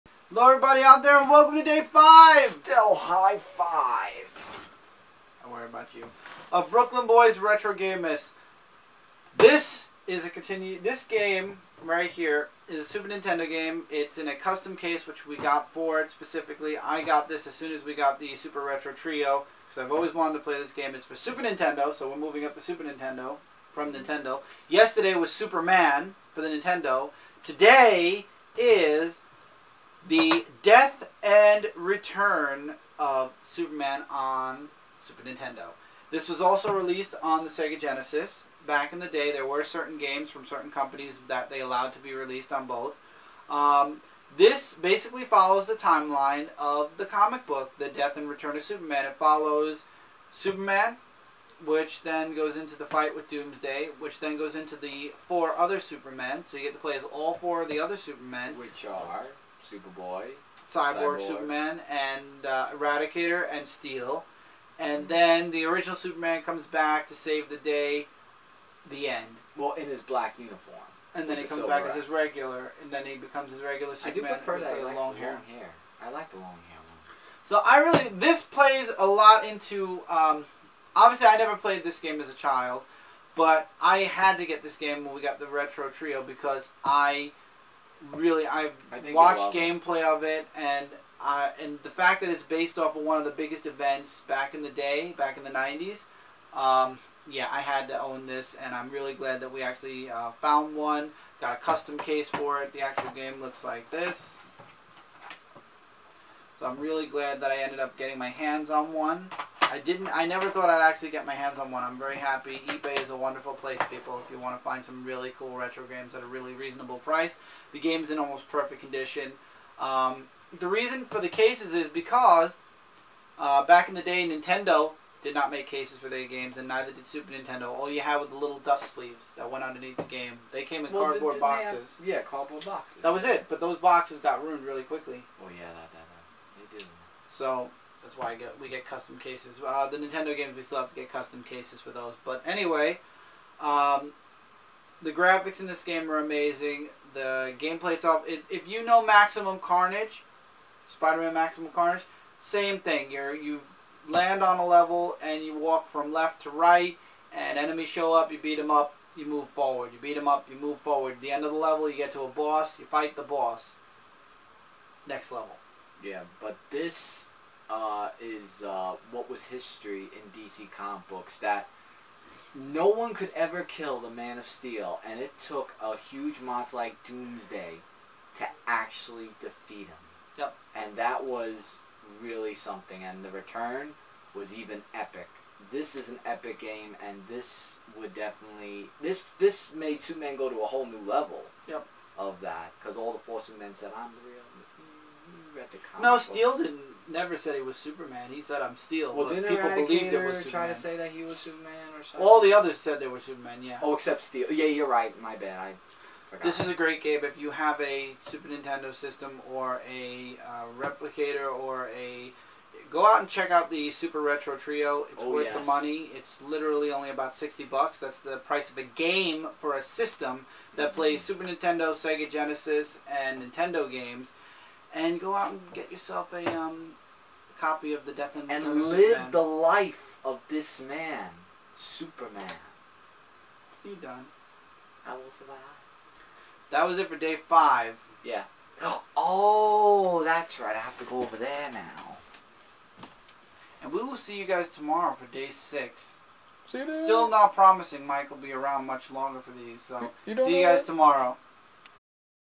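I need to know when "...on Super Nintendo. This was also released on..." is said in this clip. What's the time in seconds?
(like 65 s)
34 s.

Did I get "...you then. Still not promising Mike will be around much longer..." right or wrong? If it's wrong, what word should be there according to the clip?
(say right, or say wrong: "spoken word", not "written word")
right.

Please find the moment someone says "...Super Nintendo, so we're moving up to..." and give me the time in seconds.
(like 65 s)
21 s.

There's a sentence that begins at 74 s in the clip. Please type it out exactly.
I do prefer that he long hair.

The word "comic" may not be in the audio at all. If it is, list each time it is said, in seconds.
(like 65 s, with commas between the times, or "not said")
47 s, 170 s, 195 s.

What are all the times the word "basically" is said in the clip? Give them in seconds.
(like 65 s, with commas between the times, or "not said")
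44 s.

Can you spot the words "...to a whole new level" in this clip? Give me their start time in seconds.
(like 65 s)
190 s.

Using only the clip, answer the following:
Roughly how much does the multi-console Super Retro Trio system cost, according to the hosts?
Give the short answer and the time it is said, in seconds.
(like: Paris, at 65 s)
$60, at 217 s.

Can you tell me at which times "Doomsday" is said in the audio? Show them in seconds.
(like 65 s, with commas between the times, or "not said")
53 s, 177 s.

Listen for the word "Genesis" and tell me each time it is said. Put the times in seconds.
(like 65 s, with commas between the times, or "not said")
37 s, 222 s.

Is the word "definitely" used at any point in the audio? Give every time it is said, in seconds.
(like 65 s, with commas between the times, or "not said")
188 s.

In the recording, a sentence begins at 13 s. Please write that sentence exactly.
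It's in a custom case which we got for it specifically.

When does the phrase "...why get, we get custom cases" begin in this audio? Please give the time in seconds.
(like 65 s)
138 s.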